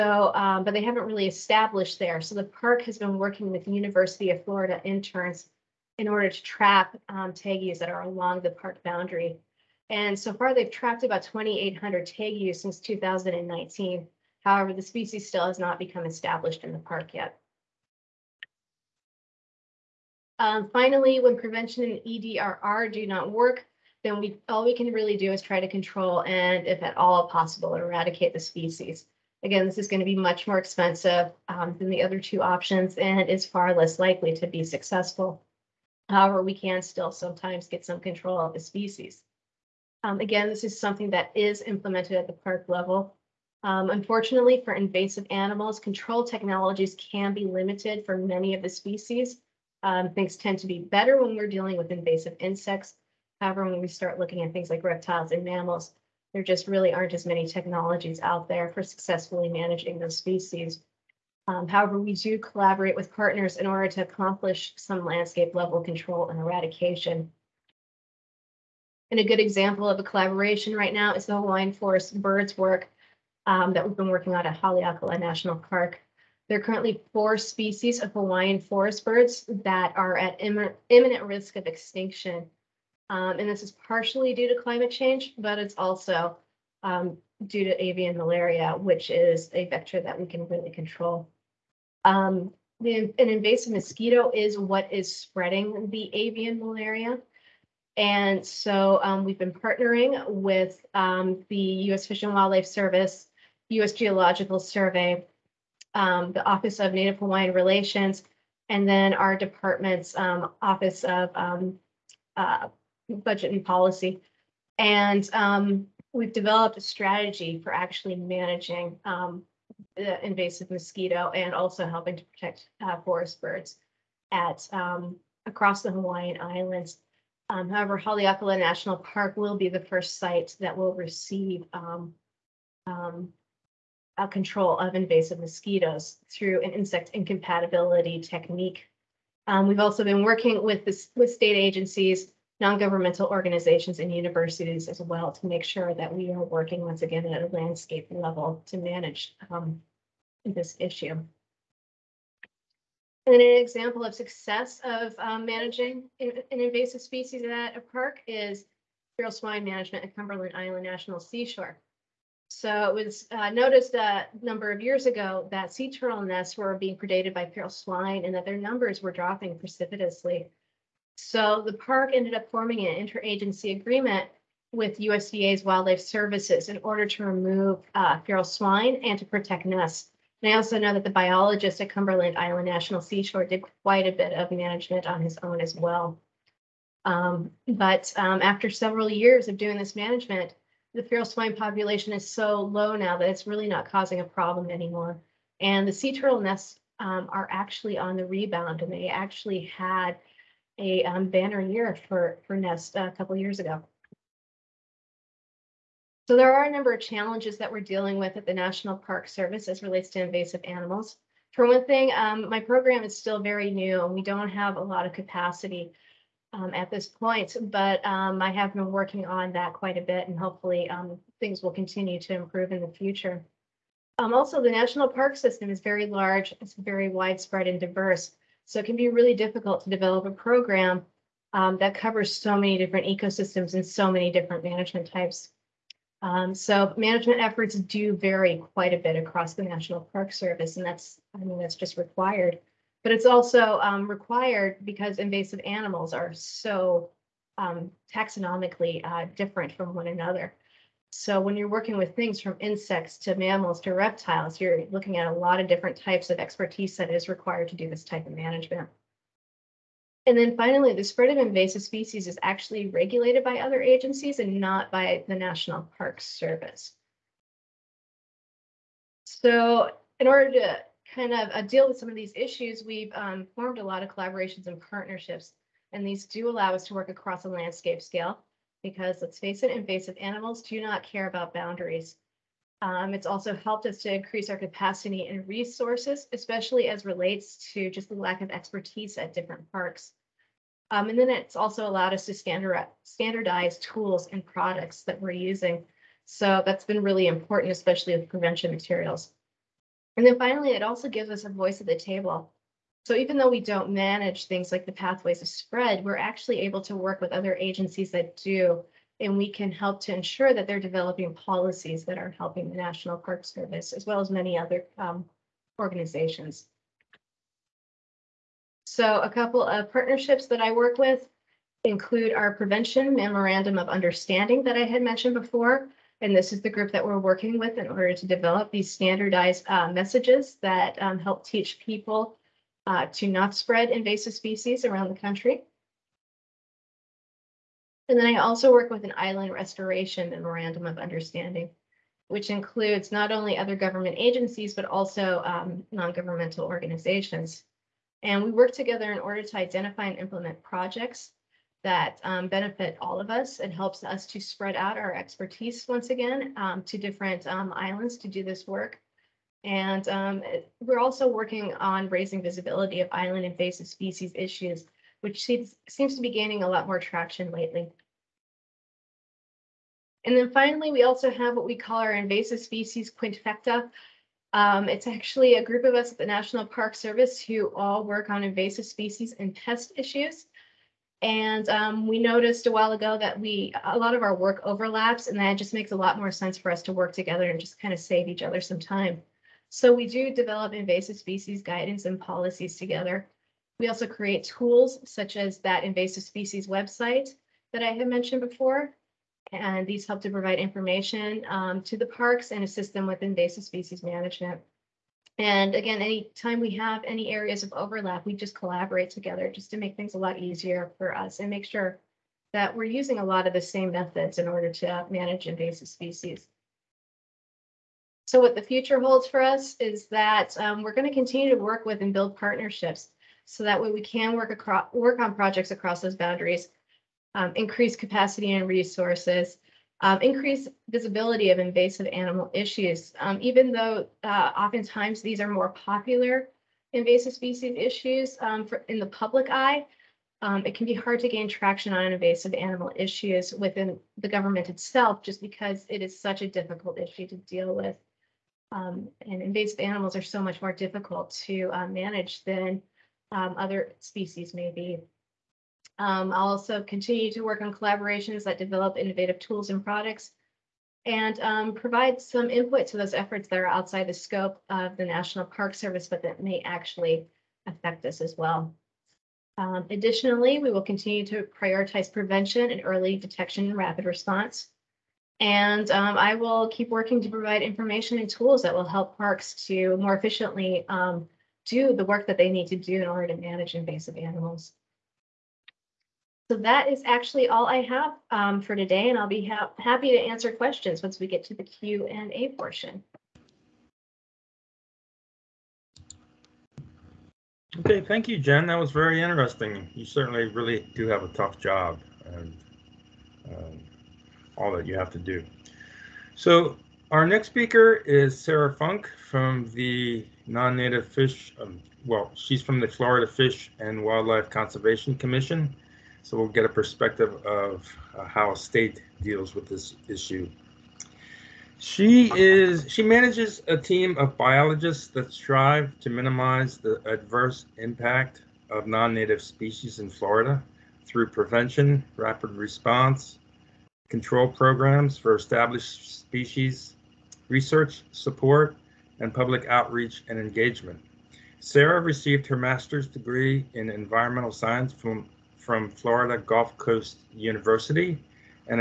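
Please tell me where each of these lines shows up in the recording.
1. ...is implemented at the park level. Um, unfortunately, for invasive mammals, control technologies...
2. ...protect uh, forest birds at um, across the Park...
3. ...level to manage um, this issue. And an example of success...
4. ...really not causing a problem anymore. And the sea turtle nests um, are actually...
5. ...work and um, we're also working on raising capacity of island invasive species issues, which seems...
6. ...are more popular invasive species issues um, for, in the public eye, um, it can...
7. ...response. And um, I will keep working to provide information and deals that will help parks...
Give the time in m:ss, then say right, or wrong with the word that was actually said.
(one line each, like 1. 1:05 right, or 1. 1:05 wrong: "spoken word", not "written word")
1. 0:41 wrong: "animals", not "mammals"
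2. 2:02 wrong: "Hawaiian", not "Park"
3. 2:28 right
4. 3:13 right
5. 5:58 wrong: "visibility", not "capacity"
6. 7:15 right
7. 7:54 wrong: "tools", not "deals".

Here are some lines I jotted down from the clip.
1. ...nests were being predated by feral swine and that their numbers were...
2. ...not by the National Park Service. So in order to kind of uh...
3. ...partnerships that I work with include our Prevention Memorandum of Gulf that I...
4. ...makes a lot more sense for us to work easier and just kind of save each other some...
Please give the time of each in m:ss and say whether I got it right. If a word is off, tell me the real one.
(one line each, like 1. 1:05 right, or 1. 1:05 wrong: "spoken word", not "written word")
1. 2:46 right
2. 4:24 right
3. 5:19 wrong: "Understanding", not "Gulf"
4. 6:25 wrong: "together", not "easier".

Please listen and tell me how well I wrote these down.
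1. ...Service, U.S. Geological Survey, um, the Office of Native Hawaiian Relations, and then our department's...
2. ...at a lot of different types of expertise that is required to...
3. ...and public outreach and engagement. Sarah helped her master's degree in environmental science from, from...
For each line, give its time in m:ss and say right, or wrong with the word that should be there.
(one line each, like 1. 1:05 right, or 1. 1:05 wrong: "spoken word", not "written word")
1. 1:42 right
2. 4:15 right
3. 8:59 wrong: "received", not "helped".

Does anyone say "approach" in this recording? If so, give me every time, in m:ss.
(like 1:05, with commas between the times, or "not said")
not said.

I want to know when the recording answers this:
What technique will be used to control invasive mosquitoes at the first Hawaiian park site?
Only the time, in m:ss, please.
2:16.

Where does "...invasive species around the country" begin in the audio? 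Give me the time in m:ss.
5:33.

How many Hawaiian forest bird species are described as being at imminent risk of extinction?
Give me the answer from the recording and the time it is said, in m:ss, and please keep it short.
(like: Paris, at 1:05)
4, at 1:17.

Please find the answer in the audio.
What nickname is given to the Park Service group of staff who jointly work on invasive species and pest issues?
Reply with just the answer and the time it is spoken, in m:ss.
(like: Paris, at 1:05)
Invasive species quintfecta, at 6:12.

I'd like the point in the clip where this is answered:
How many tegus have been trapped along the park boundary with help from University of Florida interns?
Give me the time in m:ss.
0:11.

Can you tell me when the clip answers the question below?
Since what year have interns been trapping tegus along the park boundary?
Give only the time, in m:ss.
0:12.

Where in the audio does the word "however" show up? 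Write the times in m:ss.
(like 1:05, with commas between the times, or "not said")
0:14, 0:36, 0:53, 1:01, 2:07.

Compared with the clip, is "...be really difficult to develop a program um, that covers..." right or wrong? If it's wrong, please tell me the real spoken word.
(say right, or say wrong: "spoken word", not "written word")
right.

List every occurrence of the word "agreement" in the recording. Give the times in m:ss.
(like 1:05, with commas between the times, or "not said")
2:53.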